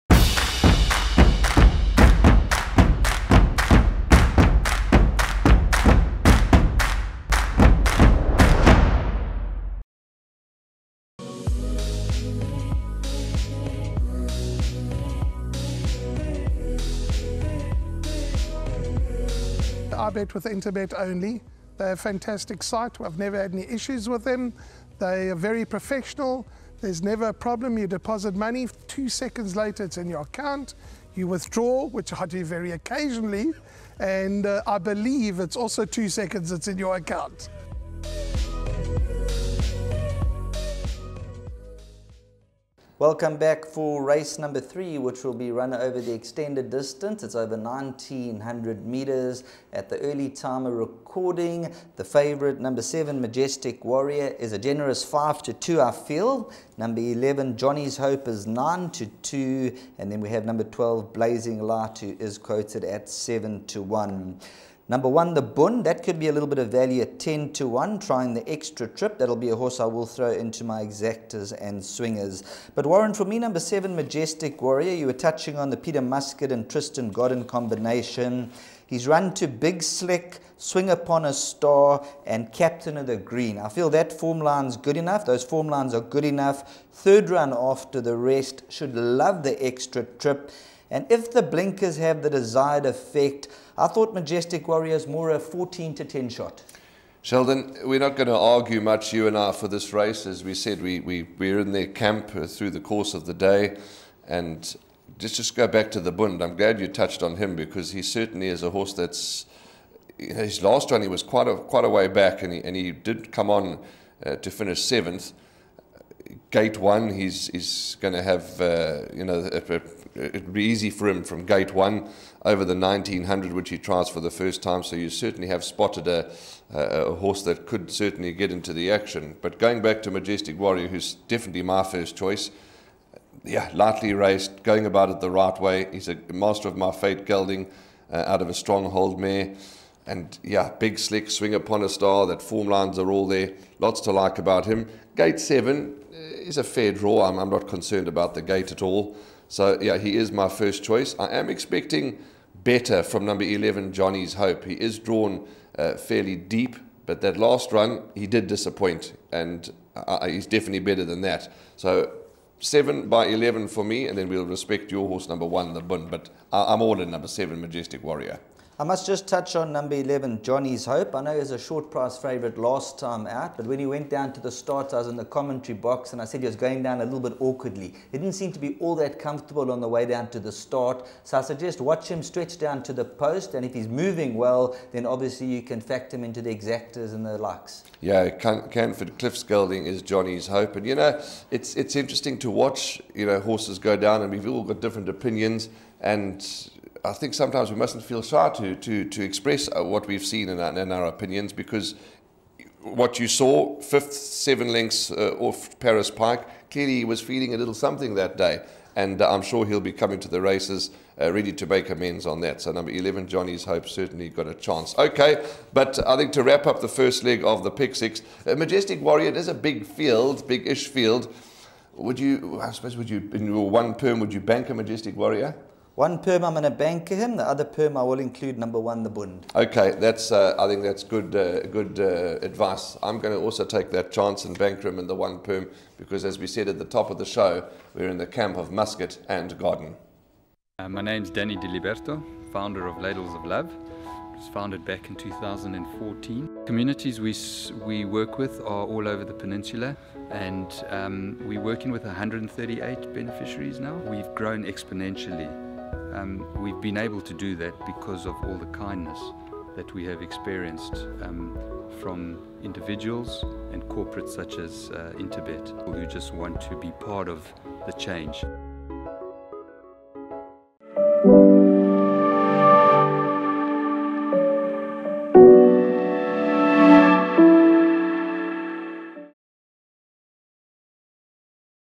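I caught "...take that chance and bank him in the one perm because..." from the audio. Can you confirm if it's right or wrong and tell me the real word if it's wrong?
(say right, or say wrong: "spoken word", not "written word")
right.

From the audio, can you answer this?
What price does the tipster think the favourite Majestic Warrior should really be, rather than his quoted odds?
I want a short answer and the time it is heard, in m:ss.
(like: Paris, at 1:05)
14 to 10, at 1:35.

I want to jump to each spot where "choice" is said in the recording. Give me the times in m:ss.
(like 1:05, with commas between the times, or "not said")
2:12, 2:30.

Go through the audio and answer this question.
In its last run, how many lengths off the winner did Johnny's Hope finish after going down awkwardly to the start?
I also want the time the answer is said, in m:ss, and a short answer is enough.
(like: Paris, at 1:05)
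7, at 3:24.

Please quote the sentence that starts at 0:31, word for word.
You withdraw, which I do very occasionally.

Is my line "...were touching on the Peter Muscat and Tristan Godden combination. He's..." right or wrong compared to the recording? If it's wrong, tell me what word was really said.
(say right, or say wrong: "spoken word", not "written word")
right.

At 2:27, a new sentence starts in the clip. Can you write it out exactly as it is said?
I'm, I'm not concerned about the gate at all.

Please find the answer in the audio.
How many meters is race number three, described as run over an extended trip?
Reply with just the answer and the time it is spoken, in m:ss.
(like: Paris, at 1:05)
1900, at 0:47.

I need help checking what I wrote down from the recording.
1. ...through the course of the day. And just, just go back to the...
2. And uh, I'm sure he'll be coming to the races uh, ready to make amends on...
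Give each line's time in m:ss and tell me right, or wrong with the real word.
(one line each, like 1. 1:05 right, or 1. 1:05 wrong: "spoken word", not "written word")
1. 1:42 right
2. 3:28 right.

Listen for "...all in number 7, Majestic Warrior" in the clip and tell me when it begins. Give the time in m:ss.
2:46.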